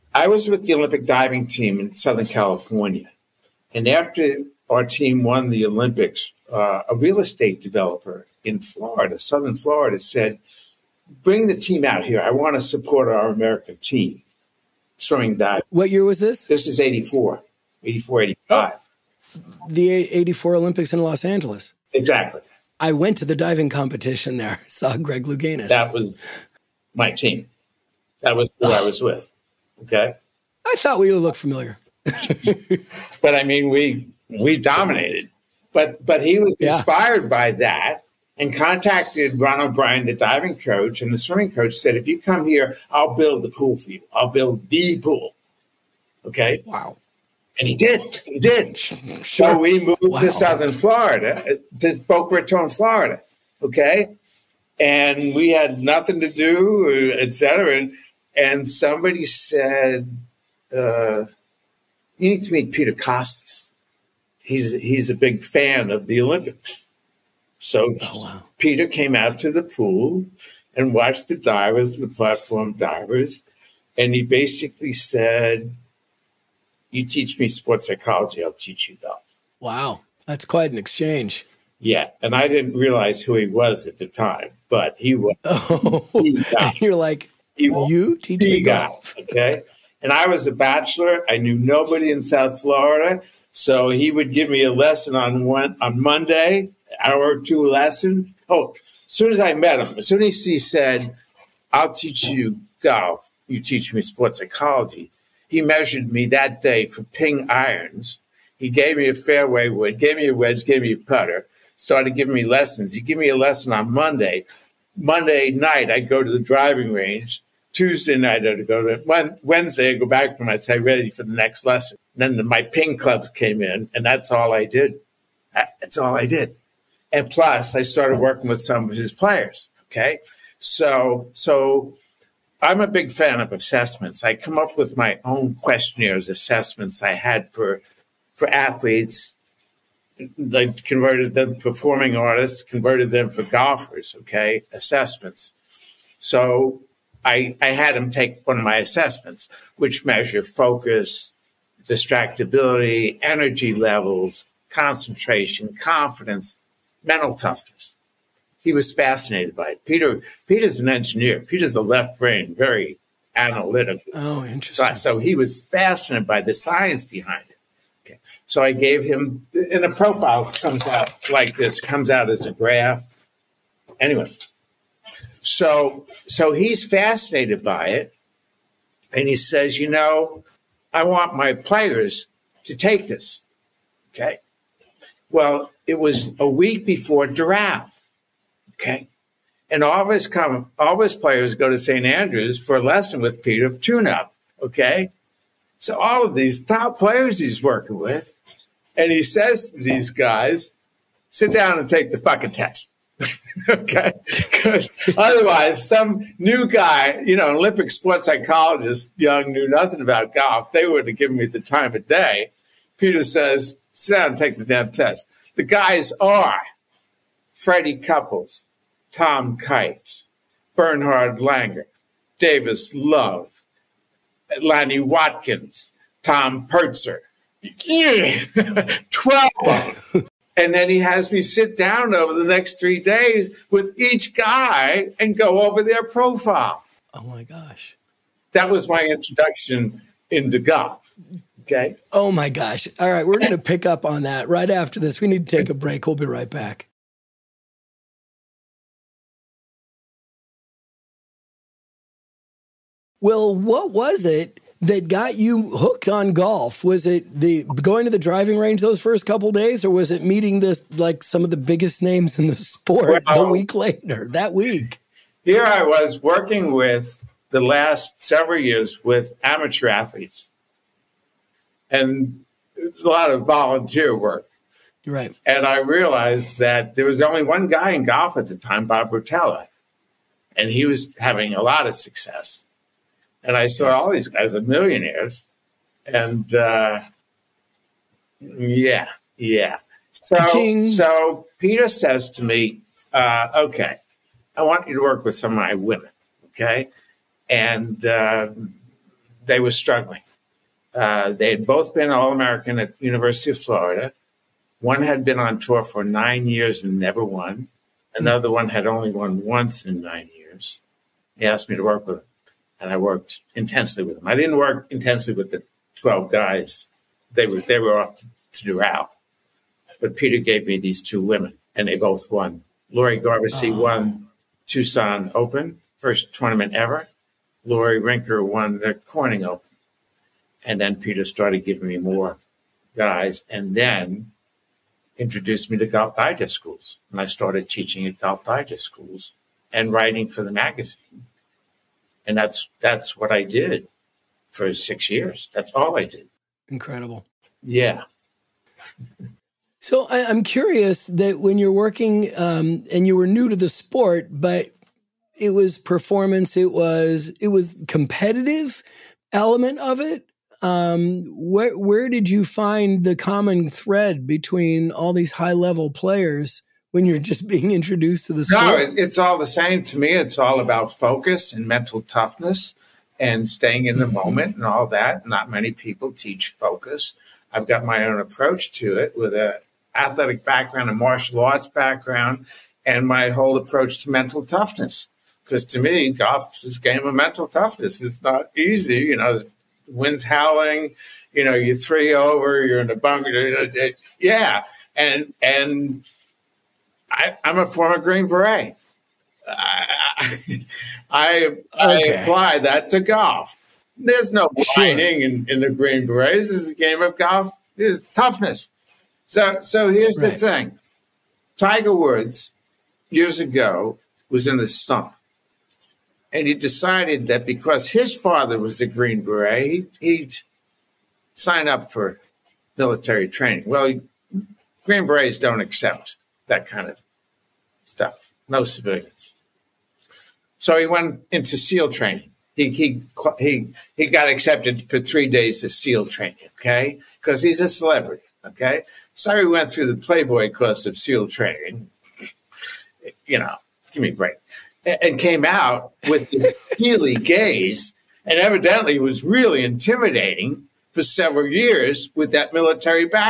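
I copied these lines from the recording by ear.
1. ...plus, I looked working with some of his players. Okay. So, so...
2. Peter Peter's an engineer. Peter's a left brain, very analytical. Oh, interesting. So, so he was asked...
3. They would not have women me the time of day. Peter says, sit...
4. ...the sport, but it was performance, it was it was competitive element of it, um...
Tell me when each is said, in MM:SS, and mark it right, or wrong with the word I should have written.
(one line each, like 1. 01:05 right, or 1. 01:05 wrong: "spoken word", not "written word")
1. 02:07 wrong: "started", not "looked"
2. 02:39 wrong: "fascinated", not "asked"
3. 03:30 wrong: "given", not "women"
4. 05:53 right.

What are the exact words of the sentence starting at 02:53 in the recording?
Anyway, so so he's fascinated by it, and he says, you know, I want my players to take this.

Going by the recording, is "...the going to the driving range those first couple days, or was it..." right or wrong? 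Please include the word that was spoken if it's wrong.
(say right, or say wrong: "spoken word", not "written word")
right.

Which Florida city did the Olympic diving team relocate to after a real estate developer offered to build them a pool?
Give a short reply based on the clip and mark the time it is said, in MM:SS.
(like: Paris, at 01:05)
Boca Raton, at 00:52.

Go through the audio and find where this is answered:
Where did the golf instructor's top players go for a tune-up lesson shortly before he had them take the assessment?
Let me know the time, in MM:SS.
03:11.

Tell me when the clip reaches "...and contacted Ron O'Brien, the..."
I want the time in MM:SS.
00:38.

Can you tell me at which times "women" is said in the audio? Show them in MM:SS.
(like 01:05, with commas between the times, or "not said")
04:55, 05:21.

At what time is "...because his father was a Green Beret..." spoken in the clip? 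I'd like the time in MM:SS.
06:57.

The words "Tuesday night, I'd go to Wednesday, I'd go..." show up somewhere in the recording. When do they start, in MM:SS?
01:57.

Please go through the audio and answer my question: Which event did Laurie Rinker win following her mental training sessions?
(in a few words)
Corning Open.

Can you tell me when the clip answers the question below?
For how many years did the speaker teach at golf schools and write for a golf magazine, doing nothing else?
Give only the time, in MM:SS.
05:44.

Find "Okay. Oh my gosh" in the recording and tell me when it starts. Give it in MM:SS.
04:01.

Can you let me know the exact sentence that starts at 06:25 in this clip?
Because to me, golf is a game of mental toughness.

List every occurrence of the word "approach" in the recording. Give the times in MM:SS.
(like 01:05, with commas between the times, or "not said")
06:18, 06:23.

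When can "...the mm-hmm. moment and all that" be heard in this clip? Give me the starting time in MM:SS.
06:13.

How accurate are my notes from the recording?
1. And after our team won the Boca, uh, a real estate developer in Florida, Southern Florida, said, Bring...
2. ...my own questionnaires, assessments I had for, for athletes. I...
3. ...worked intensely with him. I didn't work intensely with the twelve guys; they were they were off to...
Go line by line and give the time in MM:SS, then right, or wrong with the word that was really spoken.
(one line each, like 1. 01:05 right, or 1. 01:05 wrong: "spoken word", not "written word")
1. 00:03 wrong: "Olympics", not "Boca"
2. 02:14 right
3. 05:12 right.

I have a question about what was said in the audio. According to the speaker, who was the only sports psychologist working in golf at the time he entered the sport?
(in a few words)
Bob Rotella.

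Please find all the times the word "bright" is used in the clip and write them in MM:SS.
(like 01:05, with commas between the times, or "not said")
not said.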